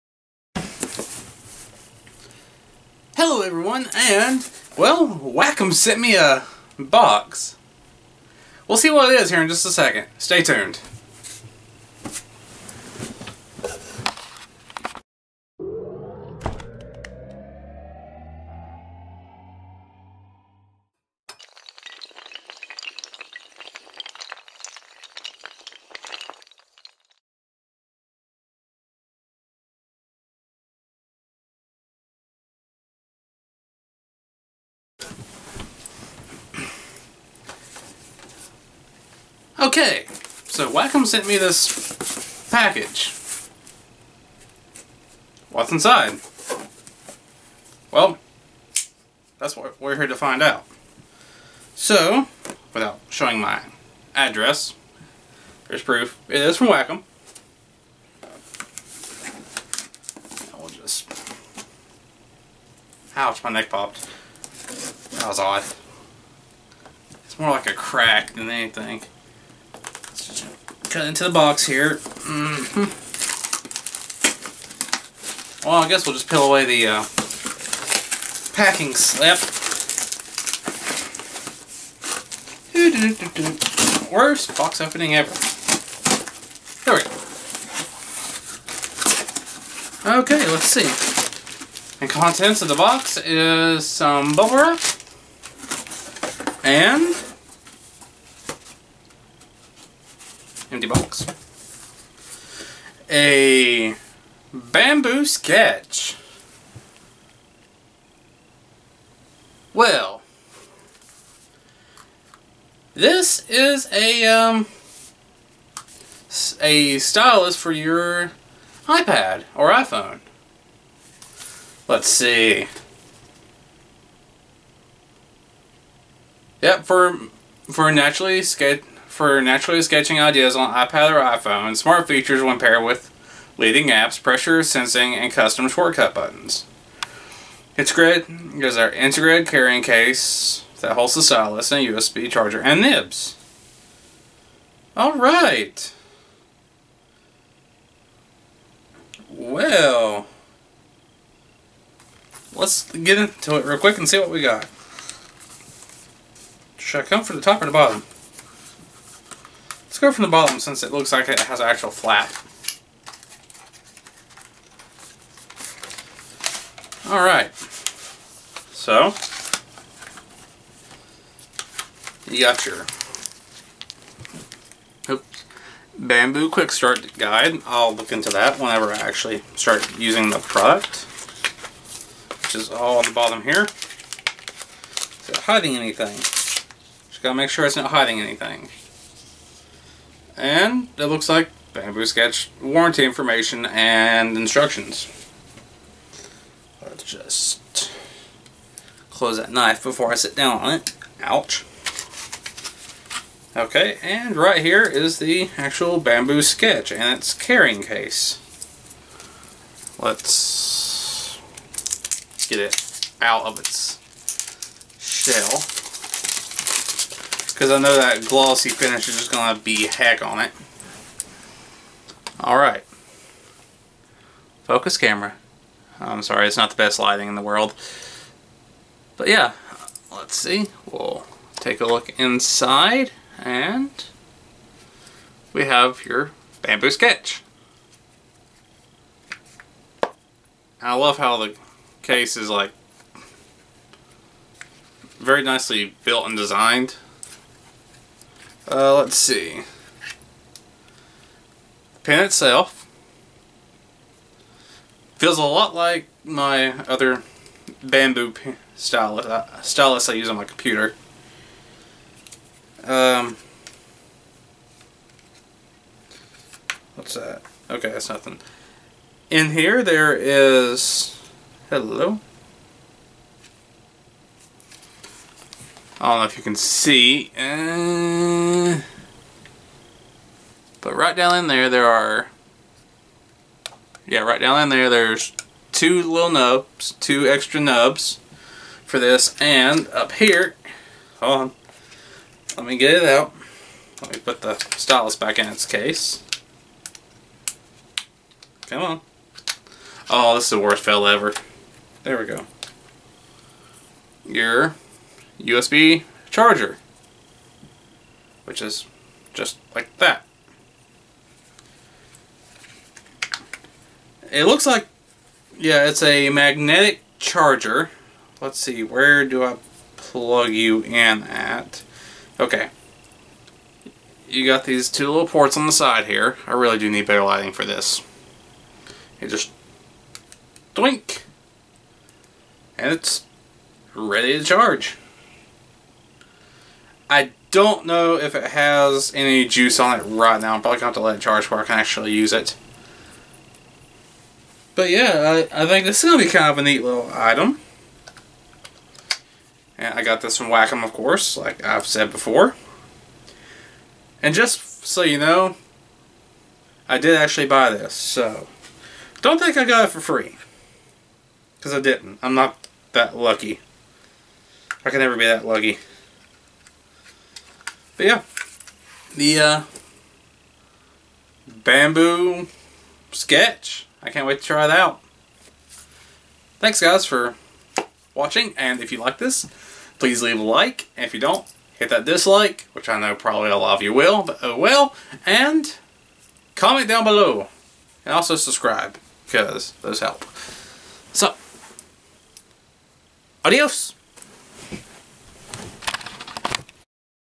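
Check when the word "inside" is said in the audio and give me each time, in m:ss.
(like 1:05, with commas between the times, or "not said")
0:45, 3:52.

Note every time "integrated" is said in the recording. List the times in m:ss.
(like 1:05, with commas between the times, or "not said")
2:18.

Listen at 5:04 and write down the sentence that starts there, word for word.
Your USB charger, which is just like that.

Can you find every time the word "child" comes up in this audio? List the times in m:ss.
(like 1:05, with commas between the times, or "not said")
not said.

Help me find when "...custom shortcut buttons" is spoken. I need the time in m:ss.
2:15.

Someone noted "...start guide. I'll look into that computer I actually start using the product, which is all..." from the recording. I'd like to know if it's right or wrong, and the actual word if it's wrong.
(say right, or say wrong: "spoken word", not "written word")
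wrong: "whenever", not "computer".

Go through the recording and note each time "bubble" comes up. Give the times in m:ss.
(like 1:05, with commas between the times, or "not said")
1:34.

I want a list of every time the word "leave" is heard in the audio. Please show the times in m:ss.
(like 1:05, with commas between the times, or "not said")
6:20.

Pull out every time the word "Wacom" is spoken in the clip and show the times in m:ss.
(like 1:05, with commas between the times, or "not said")
0:05, 0:40, 0:56, 5:50.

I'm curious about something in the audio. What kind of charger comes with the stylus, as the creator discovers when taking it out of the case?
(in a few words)
magnetic charger.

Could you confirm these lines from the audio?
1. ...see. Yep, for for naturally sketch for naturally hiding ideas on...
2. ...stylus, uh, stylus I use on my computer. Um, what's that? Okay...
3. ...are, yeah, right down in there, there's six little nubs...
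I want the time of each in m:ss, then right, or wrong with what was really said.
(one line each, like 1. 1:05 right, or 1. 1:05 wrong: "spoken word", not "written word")
1. 2:02 wrong: "sketching", not "hiding"
2. 4:18 right
3. 4:41 wrong: "two", not "six".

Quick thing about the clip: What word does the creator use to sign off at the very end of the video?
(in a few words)
adios.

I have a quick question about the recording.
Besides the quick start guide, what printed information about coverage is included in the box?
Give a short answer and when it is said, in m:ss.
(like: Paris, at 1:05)
warranty information, at 3:12.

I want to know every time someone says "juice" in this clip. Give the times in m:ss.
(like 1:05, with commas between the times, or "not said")
5:39.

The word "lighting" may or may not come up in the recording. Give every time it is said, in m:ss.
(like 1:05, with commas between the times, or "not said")
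3:46, 5:27.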